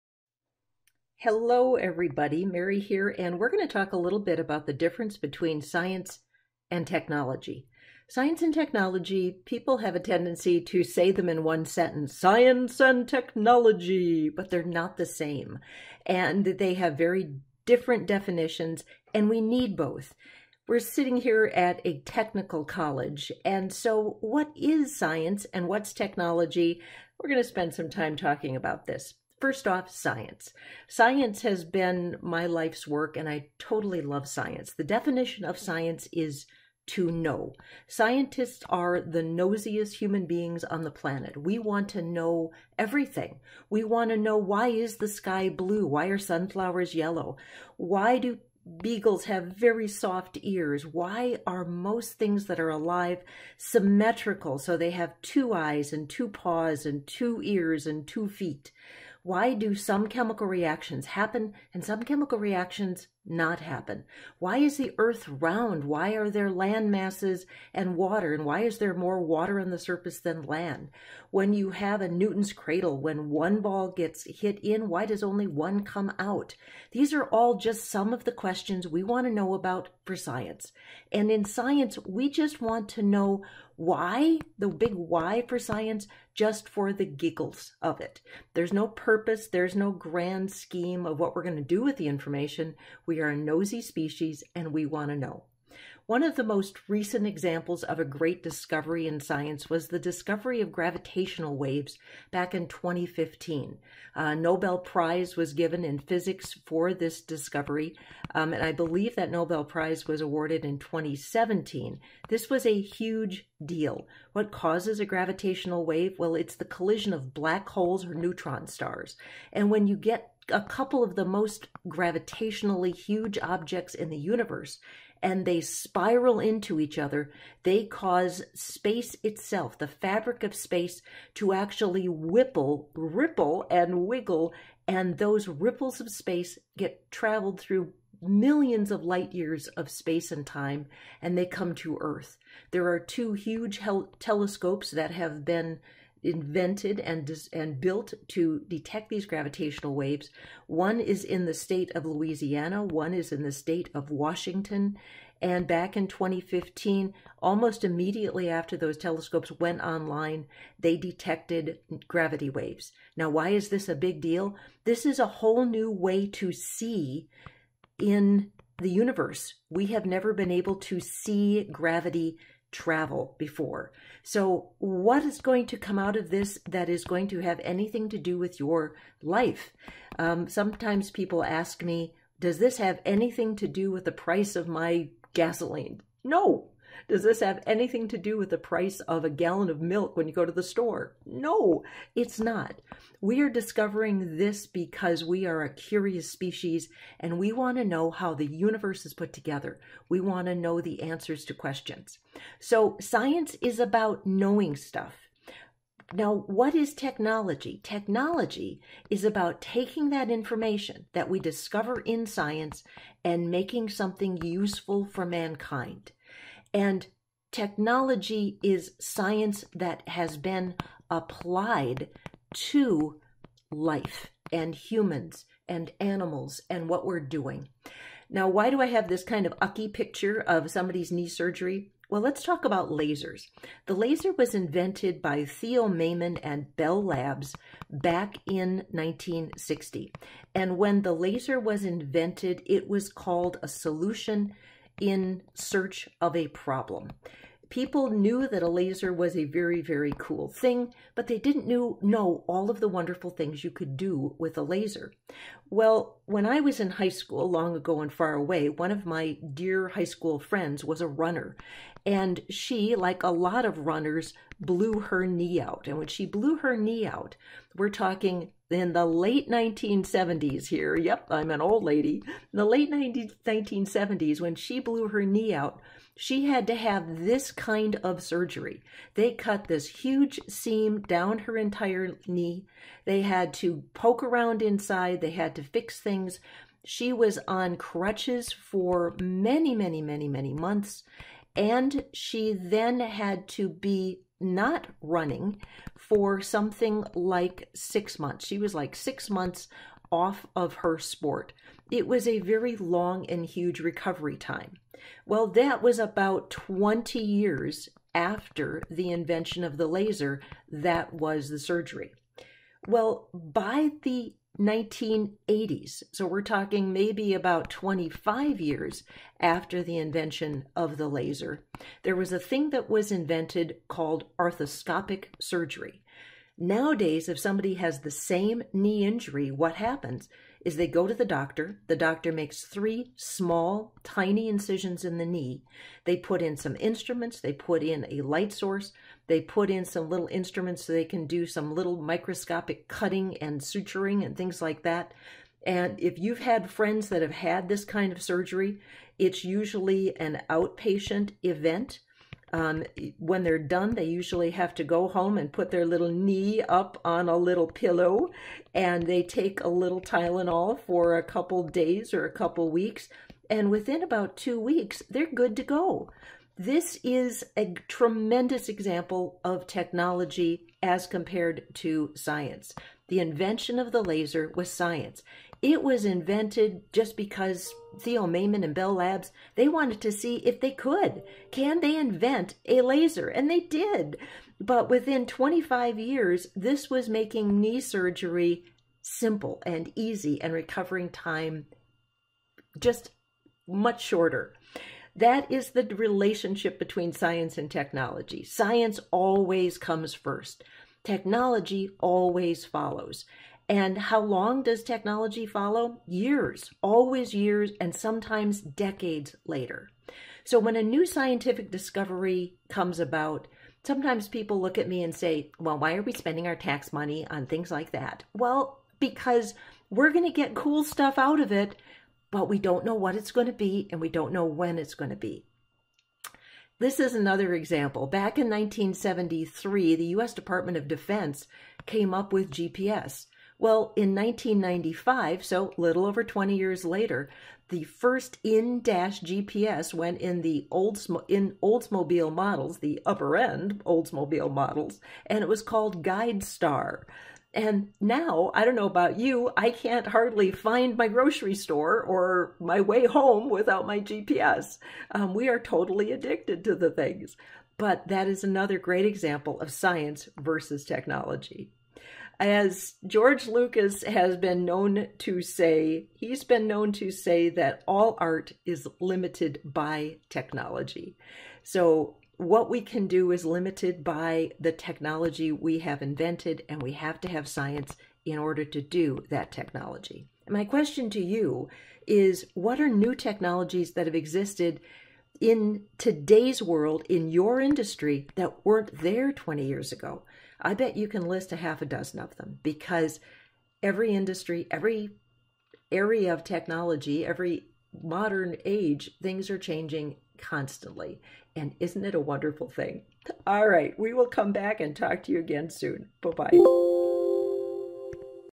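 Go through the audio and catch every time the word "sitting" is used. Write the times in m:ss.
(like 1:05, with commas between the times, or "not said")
0:20.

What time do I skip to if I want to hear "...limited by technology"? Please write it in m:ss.
7:48.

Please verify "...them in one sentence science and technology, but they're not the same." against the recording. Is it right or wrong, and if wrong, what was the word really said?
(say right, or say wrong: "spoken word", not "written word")
right.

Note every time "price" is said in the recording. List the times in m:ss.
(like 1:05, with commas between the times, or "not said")
3:04, 3:08.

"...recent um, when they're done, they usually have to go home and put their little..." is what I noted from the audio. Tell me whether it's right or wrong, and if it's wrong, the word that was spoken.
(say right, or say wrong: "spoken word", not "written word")
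wrong: "event", not "recent".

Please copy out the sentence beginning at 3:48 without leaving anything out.
Now, why do I have this kind of ucky picture of somebody's knee surgery?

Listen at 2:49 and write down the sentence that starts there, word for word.
We have never been able to see gravity travel before.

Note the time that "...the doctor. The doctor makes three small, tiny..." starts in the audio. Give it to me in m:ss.
5:31.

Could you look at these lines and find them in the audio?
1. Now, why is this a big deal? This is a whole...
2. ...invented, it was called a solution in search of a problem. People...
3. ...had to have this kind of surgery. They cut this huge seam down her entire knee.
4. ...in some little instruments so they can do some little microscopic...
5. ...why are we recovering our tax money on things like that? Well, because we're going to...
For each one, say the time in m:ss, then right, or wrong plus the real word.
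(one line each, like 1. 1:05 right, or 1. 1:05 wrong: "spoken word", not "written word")
1. 2:43 right
2. 4:01 right
3. 4:36 right
4. 5:39 right
5. 6:55 wrong: "spending", not "recovering".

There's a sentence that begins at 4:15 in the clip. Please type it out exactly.
Well, when I was in high school, long ago and far away, one of my dear high school friends was a runner.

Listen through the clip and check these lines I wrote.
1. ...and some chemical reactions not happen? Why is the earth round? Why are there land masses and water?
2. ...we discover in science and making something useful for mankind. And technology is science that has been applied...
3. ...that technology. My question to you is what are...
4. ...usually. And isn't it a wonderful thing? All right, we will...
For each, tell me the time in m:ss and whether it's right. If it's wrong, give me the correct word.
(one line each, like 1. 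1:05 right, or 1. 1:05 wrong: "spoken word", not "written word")
1. 1:01 right
2. 3:31 right
3. 7:59 right
4. 8:20 wrong: "constantly", not "usually".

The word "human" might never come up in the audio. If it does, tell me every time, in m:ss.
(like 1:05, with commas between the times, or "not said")
0:39, 3:44.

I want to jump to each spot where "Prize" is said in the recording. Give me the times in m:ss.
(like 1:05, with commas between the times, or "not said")
1:44, 1:49.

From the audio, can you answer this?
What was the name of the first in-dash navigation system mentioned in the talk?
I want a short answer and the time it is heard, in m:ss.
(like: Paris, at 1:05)
GuideStar, at 7:26.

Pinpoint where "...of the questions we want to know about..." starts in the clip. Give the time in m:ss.
1:18.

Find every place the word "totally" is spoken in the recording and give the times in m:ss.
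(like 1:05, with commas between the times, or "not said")
0:33, 7:35.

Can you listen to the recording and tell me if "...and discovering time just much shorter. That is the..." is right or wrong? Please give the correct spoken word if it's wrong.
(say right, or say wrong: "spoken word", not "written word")
wrong: "recovering", not "discovering".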